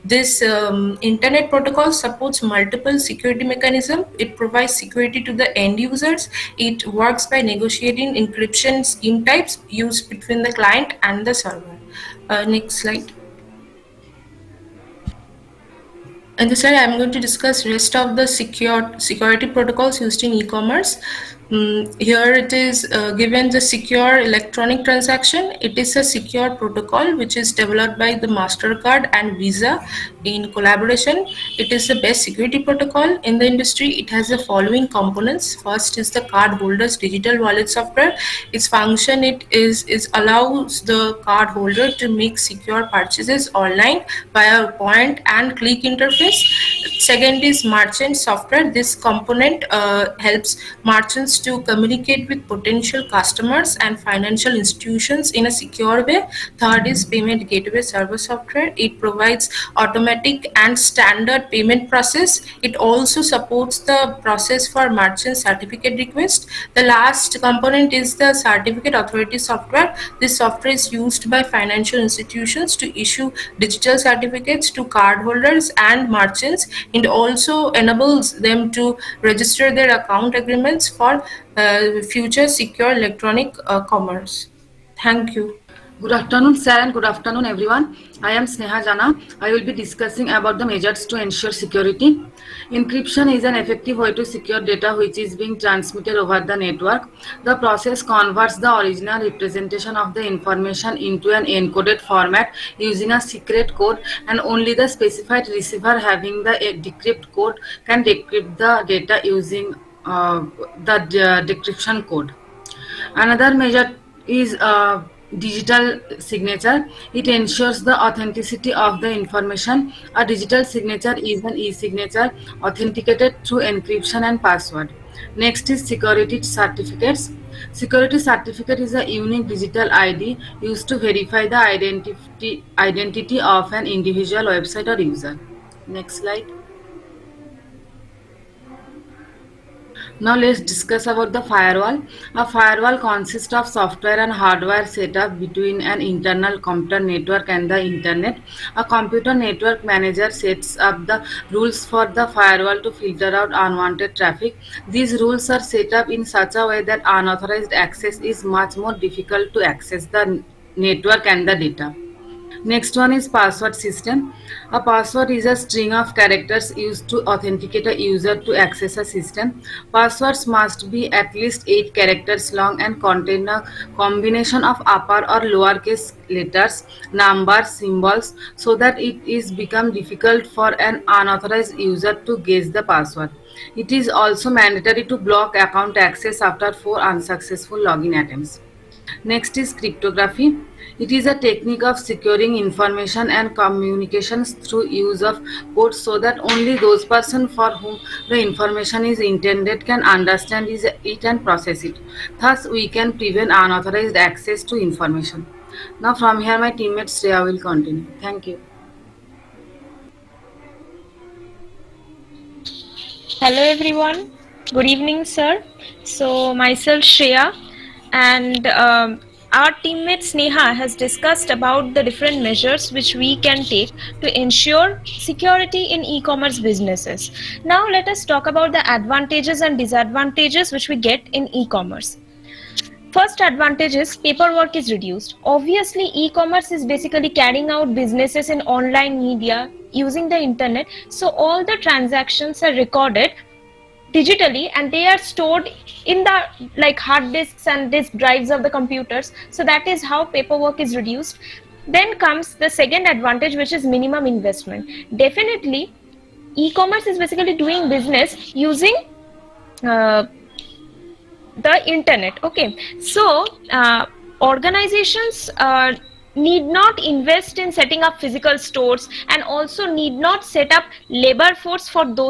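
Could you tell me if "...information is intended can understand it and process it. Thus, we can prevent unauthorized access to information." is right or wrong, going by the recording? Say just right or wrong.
right.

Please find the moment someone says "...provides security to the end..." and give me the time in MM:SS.
00:04.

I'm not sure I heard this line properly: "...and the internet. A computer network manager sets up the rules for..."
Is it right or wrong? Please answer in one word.
right.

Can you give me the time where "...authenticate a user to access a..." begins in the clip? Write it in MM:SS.
02:47.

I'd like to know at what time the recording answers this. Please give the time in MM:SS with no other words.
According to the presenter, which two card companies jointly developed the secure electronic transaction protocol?
00:28.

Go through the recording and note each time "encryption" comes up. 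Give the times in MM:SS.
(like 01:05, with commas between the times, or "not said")
00:08, 01:32, 02:03.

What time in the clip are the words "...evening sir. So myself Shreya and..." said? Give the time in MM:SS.
03:34.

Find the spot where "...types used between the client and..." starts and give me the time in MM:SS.
00:09.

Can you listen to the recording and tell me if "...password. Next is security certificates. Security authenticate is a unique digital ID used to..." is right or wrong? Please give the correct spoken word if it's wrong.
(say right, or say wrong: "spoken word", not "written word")
wrong: "certificate", not "authenticate".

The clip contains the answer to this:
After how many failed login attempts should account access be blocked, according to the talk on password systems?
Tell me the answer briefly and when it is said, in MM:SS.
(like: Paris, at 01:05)
4, at 03:06.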